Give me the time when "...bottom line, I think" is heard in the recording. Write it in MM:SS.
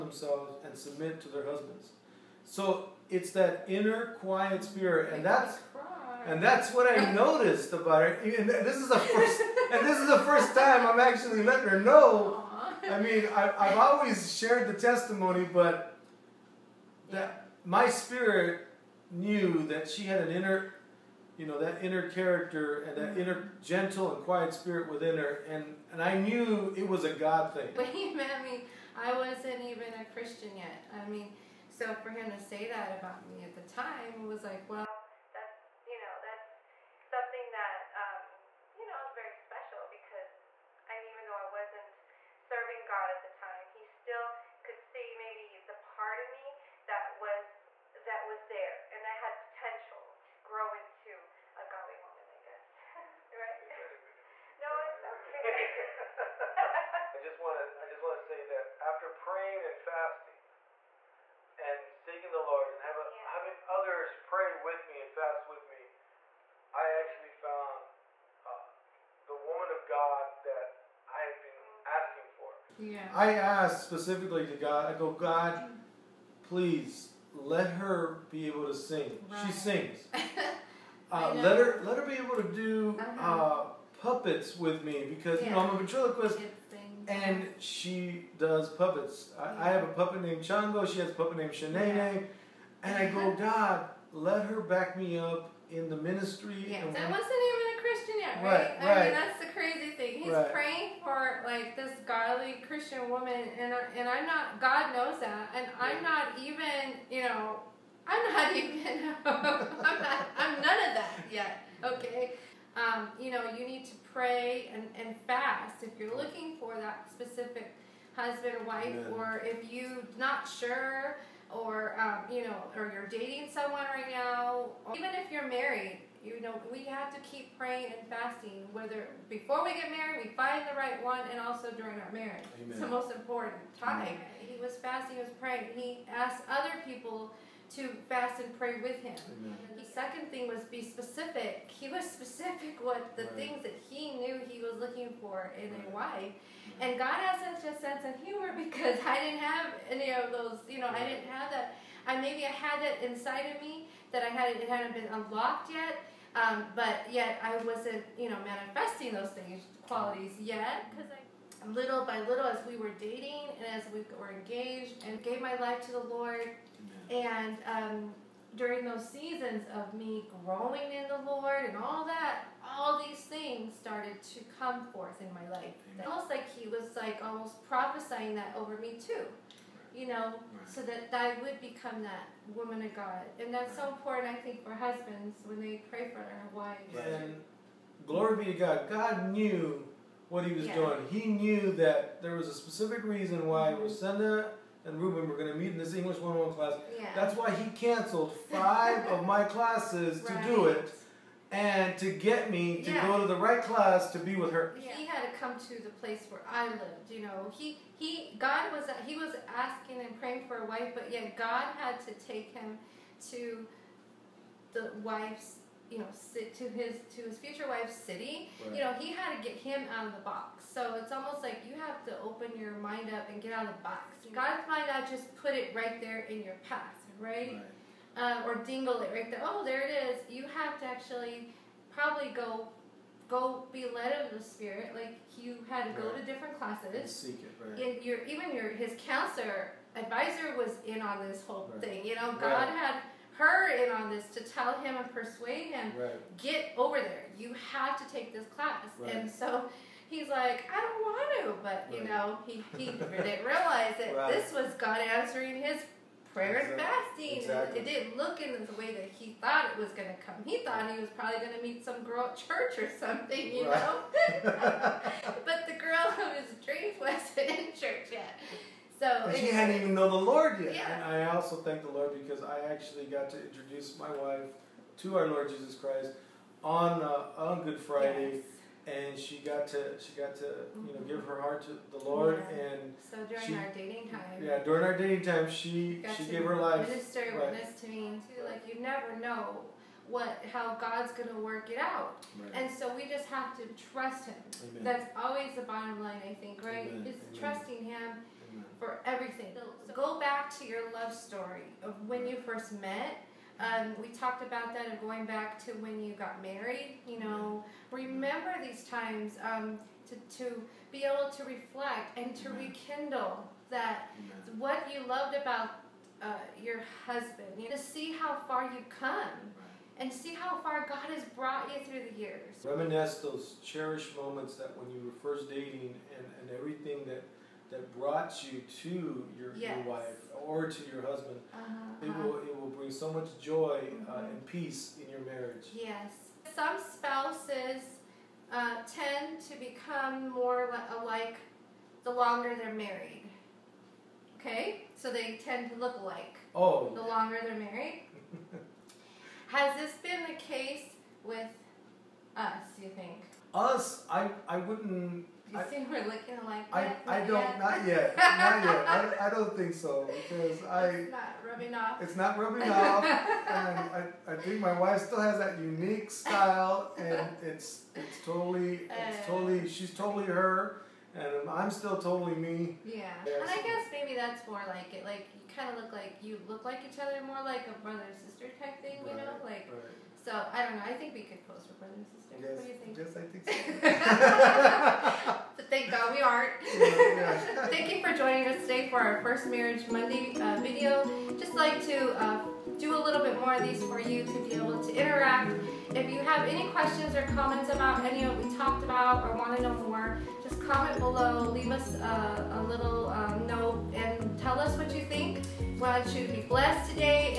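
04:55.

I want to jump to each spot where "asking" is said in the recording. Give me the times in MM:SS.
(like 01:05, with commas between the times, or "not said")
01:11, 03:29.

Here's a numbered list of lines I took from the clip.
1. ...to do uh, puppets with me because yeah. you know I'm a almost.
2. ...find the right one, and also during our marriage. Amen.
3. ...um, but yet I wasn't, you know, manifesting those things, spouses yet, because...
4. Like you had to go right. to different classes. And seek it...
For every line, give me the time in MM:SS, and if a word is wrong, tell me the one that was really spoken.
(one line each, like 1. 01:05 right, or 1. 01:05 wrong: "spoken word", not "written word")
1. 01:22 wrong: "ventriloquist", not "almost"
2. 02:10 right
3. 02:36 wrong: "qualities", not "spouses"
4. 03:54 right.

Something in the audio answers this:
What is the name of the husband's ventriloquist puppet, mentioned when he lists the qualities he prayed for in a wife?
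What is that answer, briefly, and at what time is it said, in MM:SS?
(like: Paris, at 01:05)
Chango, at 01:30.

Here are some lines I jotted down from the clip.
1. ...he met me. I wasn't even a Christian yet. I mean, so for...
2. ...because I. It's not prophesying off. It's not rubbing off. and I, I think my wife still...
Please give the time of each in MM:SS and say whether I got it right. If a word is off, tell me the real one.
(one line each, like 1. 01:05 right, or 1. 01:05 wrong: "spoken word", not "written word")
1. 00:27 right
2. 06:00 wrong: "rubbing", not "prophesying".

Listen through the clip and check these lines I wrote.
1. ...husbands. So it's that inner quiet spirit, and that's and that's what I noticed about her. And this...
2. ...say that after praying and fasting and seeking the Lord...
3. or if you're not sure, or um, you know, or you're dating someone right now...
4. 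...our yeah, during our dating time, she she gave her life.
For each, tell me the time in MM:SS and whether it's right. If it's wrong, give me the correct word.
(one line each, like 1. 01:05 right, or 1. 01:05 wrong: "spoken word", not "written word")
1. 00:01 right
2. 00:58 right
3. 01:59 right
4. 04:43 right.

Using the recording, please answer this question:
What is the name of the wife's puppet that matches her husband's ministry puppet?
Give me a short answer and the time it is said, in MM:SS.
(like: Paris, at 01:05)
Shanae, at 01:31.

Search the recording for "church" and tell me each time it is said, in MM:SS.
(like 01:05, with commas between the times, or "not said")
04:22, 04:27.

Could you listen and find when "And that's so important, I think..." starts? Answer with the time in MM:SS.
03:03.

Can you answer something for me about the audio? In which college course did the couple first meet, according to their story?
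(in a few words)
English 101.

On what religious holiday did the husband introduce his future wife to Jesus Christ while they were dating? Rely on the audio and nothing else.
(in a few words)
Good Friday.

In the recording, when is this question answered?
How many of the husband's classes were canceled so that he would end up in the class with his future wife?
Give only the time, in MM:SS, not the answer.
03:18.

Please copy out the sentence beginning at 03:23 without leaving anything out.
go to the right class to be with her.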